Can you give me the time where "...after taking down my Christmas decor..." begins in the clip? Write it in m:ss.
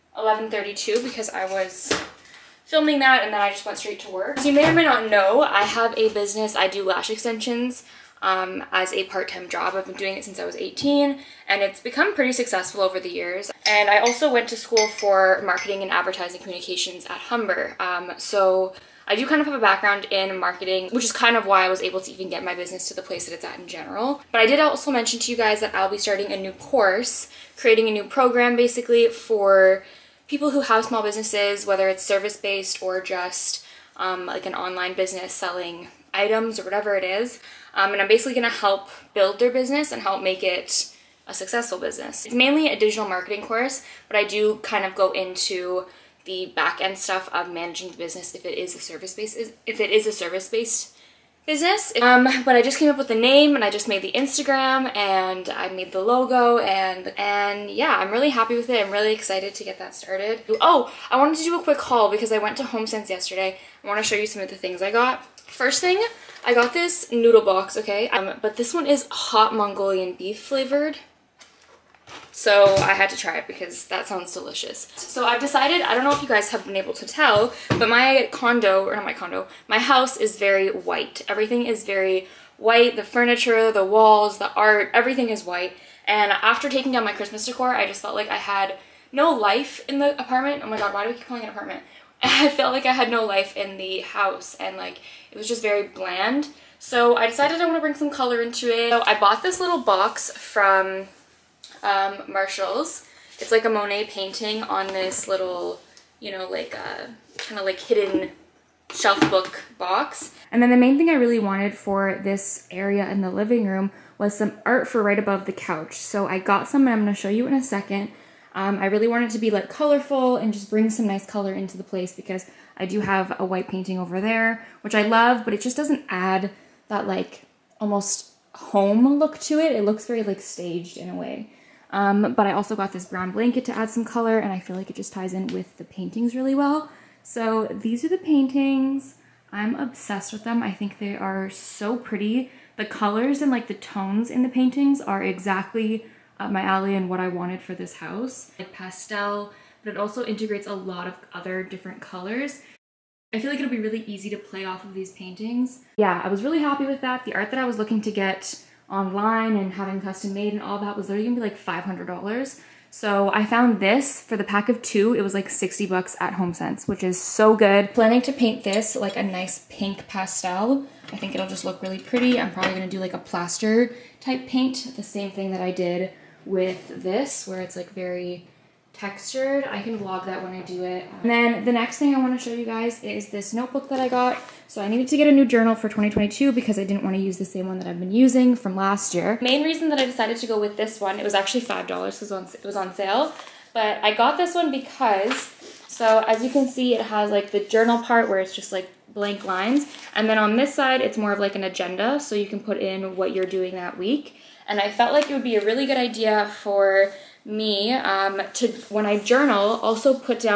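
1:26.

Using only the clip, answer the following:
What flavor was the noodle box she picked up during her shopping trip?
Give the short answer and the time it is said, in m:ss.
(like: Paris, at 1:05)
Hot Mongolian beef, at 1:09.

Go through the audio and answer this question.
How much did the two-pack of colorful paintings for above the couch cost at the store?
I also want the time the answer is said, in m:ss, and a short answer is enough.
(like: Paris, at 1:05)
$60, at 2:45.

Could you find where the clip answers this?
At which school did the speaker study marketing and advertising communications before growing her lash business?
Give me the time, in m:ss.
0:17.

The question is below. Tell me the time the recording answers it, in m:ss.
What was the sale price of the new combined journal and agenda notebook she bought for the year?
3:11.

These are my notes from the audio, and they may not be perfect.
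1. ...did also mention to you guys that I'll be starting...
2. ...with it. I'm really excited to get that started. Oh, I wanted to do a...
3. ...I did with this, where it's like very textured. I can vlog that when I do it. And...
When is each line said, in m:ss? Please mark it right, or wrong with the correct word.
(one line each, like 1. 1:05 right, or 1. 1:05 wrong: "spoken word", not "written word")
1. 0:24 right
2. 0:58 right
3. 2:55 right.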